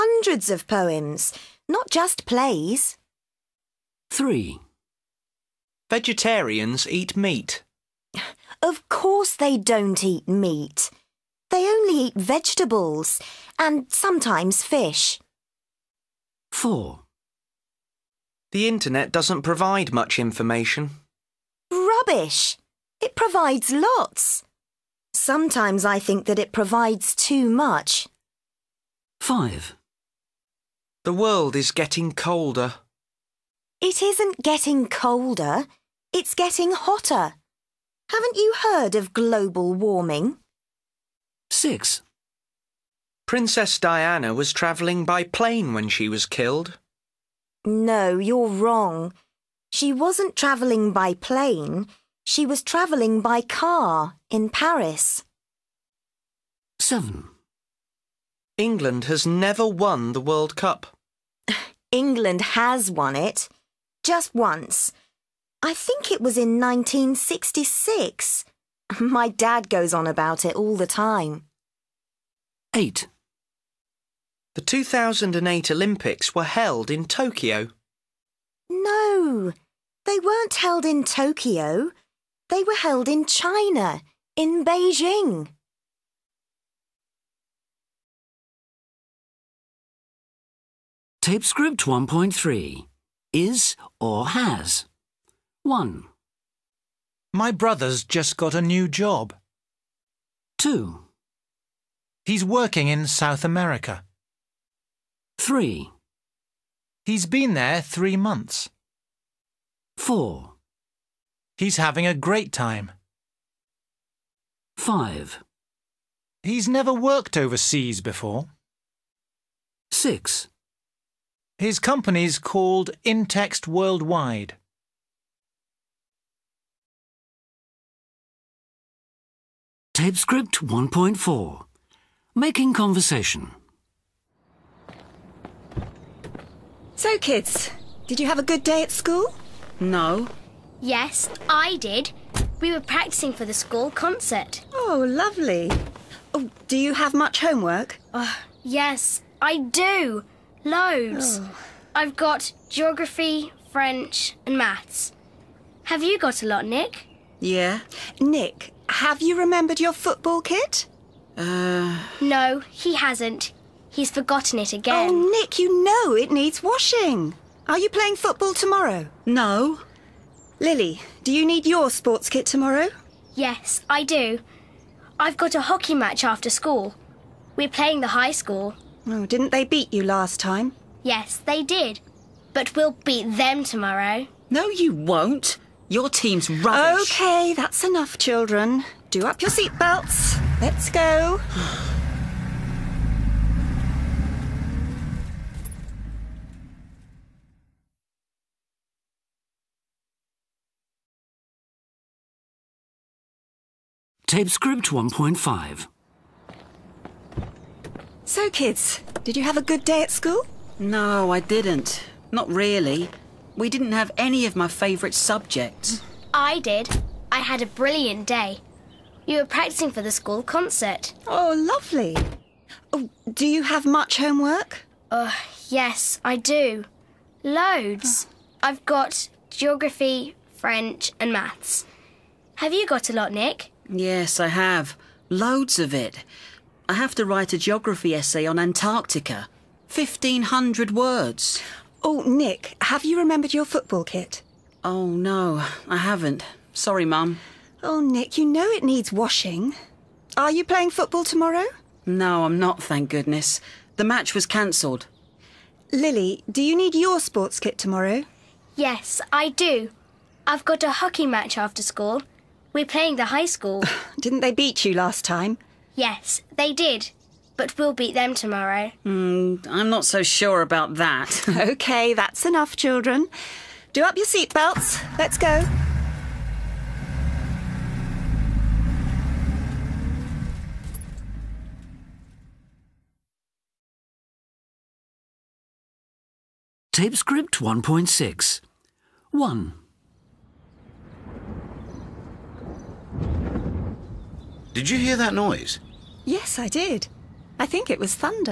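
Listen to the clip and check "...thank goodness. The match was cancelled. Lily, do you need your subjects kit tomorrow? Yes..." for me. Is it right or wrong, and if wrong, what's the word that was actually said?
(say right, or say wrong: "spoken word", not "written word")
wrong: "sports", not "subjects".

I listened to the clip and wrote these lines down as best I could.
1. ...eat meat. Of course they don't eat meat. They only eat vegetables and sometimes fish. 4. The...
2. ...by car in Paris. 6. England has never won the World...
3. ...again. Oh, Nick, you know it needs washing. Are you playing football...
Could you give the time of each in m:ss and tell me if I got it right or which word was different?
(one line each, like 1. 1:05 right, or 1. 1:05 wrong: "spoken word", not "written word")
1. 0:06 right
2. 0:53 wrong: "7", not "6"
3. 2:44 right.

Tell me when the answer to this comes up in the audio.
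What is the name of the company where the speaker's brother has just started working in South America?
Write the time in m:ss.
2:03.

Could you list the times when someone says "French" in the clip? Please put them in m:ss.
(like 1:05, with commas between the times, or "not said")
2:33, 3:50.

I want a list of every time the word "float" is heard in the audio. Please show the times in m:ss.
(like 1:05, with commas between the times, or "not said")
not said.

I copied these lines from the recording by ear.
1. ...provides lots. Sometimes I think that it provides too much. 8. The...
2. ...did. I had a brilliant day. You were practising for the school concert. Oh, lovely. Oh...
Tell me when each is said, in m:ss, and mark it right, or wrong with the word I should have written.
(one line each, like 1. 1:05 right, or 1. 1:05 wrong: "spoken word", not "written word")
1. 0:23 wrong: "5", not "8"
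2. 3:36 right.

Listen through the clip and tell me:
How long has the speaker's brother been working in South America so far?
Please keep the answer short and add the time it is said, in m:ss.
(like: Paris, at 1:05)
3 months, at 1:47.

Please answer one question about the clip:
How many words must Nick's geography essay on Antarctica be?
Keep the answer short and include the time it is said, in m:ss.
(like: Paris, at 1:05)
1,500, at 3:59.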